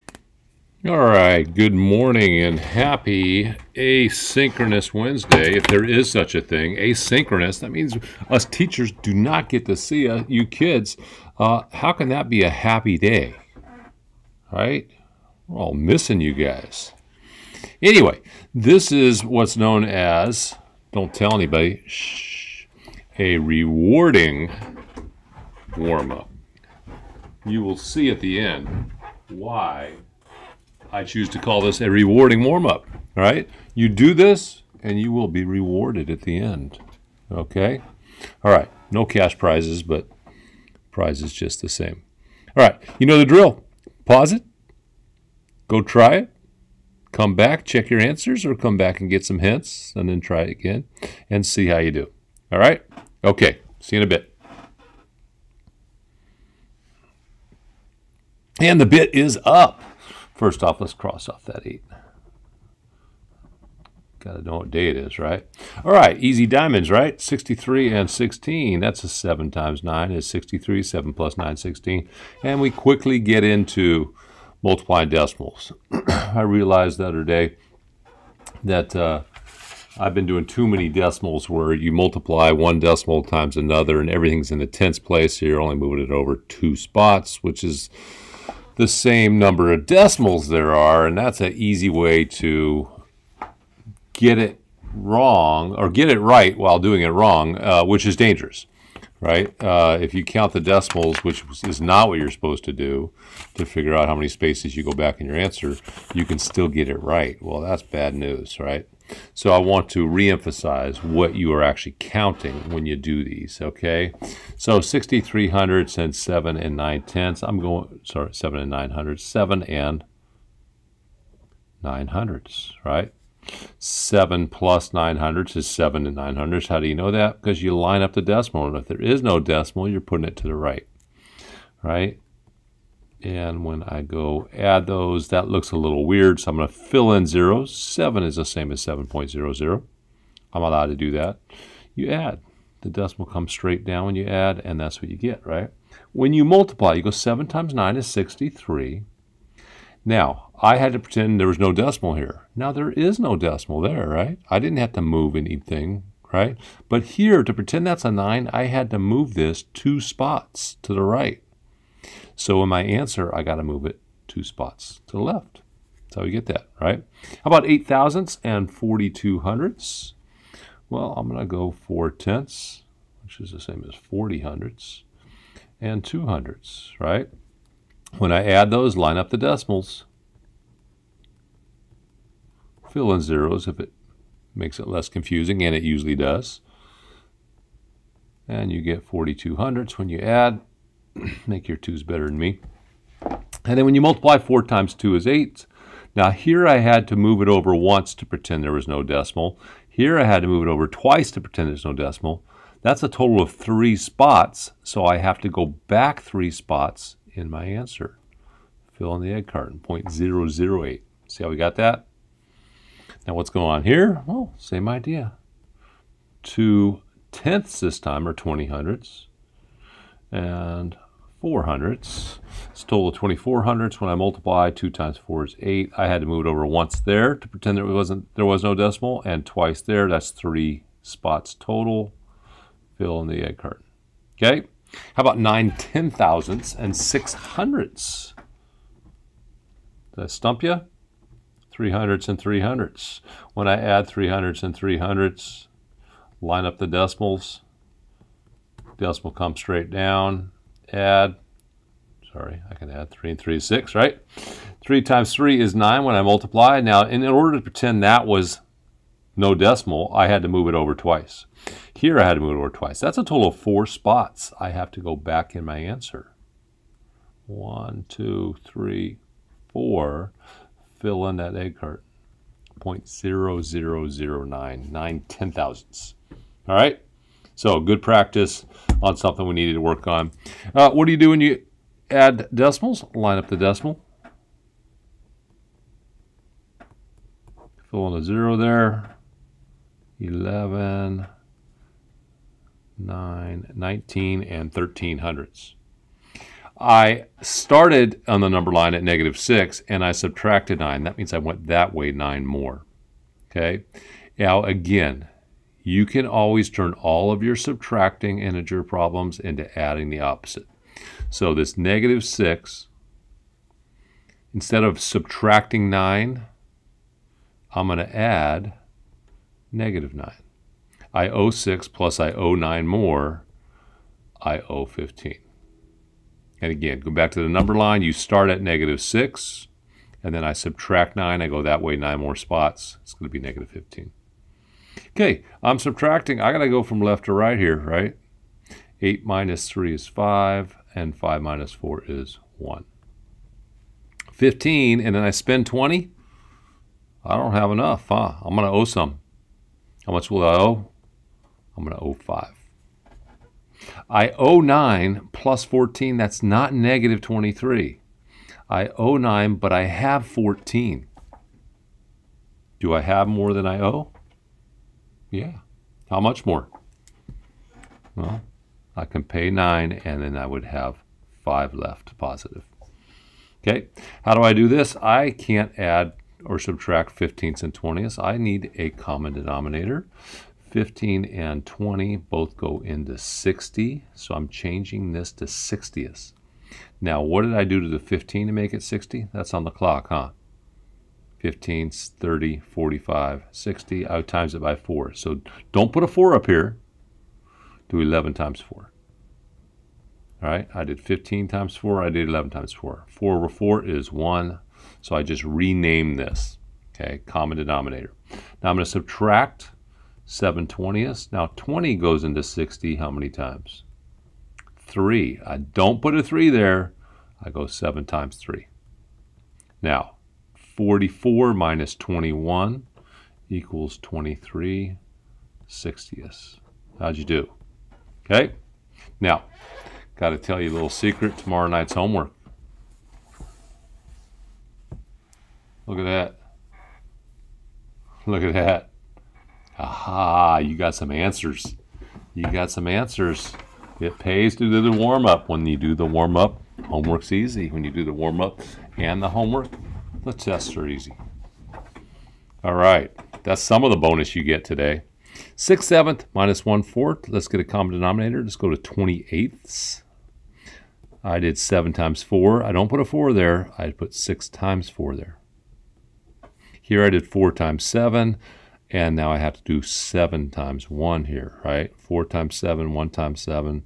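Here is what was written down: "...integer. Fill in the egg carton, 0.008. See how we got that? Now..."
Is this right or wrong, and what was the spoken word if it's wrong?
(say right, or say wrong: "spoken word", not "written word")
wrong: "answer", not "integer".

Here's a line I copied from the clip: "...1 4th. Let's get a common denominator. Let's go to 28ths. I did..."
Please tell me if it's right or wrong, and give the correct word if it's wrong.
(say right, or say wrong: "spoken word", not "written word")
right.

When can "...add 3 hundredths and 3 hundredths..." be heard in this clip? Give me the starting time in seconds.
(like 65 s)
243 s.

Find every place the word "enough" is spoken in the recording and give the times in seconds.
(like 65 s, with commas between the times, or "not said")
347 s.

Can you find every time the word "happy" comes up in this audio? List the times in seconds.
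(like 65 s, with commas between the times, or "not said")
2 s, 12 s.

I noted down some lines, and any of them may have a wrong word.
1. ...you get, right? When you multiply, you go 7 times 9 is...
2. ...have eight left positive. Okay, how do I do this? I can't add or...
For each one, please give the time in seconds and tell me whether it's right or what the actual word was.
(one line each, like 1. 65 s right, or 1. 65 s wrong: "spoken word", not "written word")
1. 145 s right
2. 370 s wrong: "five", not "eight".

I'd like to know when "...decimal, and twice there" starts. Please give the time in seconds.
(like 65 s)
228 s.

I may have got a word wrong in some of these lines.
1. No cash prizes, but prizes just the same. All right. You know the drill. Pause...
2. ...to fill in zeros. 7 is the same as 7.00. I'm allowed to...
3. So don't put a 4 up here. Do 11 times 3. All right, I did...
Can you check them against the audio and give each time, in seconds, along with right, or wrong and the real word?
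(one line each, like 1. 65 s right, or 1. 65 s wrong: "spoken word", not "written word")
1. 38 s right
2. 136 s right
3. 395 s wrong: "4", not "3".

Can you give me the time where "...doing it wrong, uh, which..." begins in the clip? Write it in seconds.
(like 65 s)
96 s.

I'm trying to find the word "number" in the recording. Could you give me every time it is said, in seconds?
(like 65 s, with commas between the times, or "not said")
89 s, 298 s, 327 s.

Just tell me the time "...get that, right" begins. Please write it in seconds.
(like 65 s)
166 s.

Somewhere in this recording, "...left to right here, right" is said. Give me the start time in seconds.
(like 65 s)
337 s.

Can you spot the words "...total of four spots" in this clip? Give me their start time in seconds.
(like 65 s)
263 s.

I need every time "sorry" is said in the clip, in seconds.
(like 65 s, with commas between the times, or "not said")
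118 s, 252 s.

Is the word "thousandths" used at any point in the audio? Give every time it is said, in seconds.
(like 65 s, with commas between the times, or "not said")
167 s, 236 s, 275 s.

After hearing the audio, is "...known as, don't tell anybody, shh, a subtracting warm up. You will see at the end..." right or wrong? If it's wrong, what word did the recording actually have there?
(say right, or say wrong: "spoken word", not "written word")
wrong: "rewarding", not "subtracting".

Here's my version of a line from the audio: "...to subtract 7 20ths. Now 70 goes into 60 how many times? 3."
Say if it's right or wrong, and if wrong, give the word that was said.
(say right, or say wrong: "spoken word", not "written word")
wrong: "20", not "70".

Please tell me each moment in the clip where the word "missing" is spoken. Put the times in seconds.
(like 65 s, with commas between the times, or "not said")
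15 s.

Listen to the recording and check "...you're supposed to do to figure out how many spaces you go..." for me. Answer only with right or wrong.
right.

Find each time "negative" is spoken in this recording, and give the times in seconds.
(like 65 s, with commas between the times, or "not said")
299 s, 311 s, 319 s, 328 s, 333 s, 356 s.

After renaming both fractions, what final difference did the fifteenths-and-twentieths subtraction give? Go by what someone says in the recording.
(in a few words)
23/60.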